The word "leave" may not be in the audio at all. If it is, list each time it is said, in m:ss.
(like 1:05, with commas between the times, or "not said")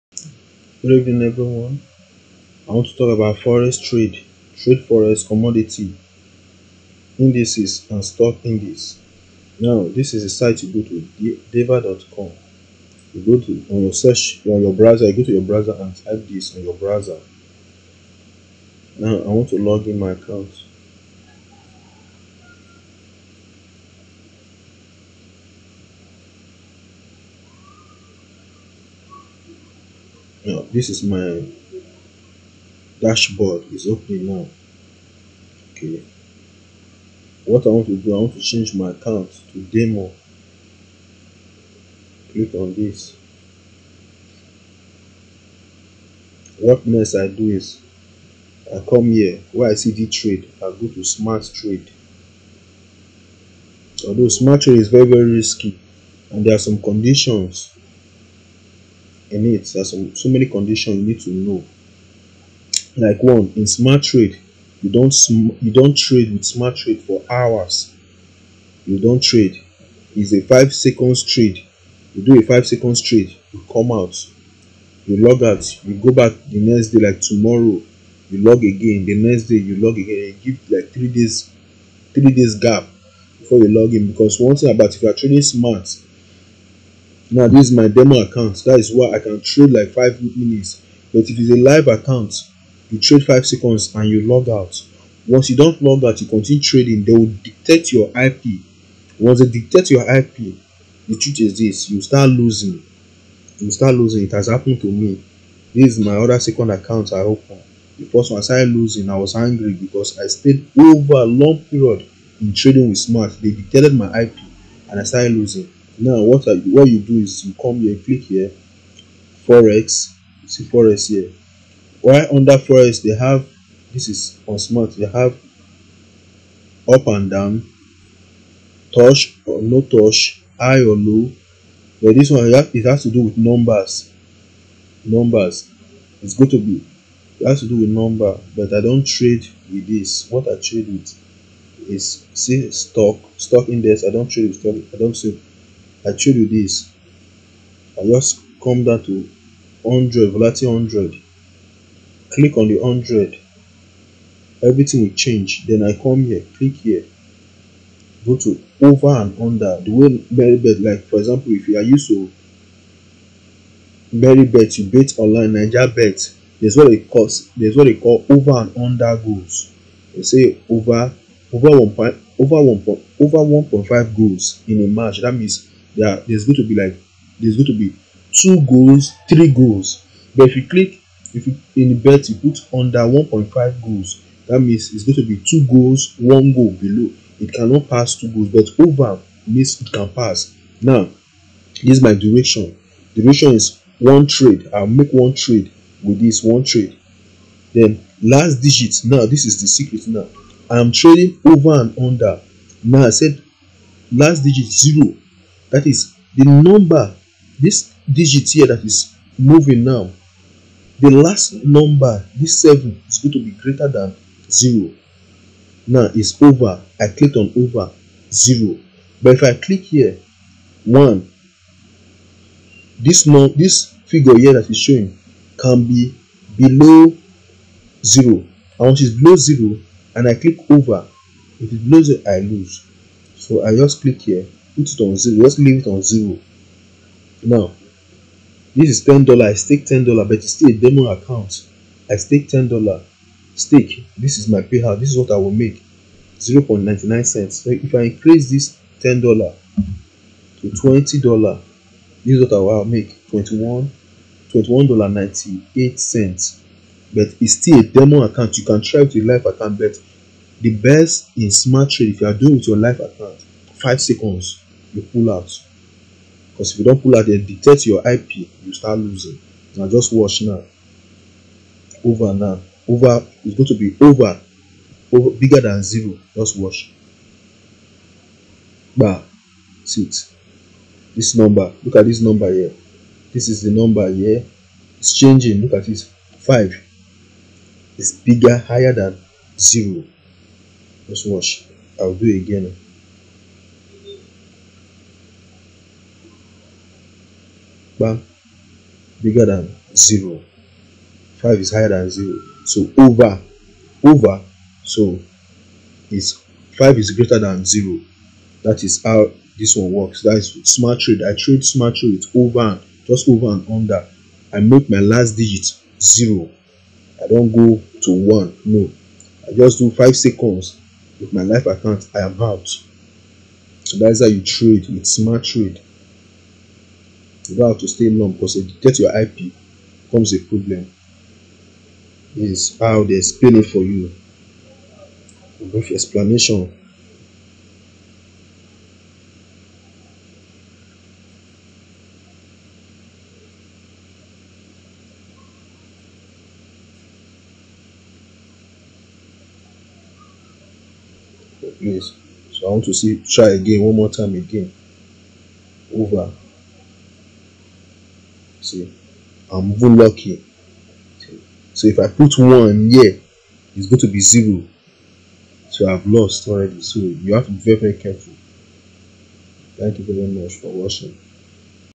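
3:55.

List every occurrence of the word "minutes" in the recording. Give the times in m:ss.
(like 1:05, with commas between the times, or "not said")
1:30.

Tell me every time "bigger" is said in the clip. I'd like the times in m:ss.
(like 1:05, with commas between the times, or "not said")
4:35, 4:48, 4:59.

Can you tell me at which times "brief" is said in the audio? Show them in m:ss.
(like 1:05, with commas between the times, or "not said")
5:35.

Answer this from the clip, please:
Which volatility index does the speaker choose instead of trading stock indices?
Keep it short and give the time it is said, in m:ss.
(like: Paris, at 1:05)
Volatility 100, at 2:30.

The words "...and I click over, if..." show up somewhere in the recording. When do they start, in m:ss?
3:50.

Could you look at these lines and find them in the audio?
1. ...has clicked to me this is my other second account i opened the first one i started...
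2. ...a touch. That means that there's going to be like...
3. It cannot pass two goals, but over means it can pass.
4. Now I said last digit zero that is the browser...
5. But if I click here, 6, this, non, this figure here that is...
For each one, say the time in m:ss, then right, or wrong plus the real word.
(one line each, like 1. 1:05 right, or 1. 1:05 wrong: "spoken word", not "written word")
1. 1:44 wrong: "happened", not "clicked"
2. 2:54 wrong: "match", not "touch"
3. 3:07 right
4. 3:22 wrong: "number", not "browser"
5. 3:39 wrong: "1", not "6".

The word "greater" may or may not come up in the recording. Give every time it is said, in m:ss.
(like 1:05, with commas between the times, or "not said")
3:33, 5:07.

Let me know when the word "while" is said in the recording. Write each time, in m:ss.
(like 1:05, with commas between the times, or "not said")
not said.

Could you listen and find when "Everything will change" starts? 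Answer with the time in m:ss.
2:34.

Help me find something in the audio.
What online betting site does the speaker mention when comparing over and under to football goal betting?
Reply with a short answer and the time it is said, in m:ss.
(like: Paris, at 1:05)
Niger bet, at 2:45.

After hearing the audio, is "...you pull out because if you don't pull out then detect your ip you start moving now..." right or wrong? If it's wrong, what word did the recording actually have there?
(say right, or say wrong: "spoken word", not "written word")
wrong: "losing", not "moving".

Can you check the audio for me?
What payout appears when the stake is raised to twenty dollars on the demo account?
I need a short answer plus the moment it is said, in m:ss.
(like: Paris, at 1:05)
$21.98, at 4:13.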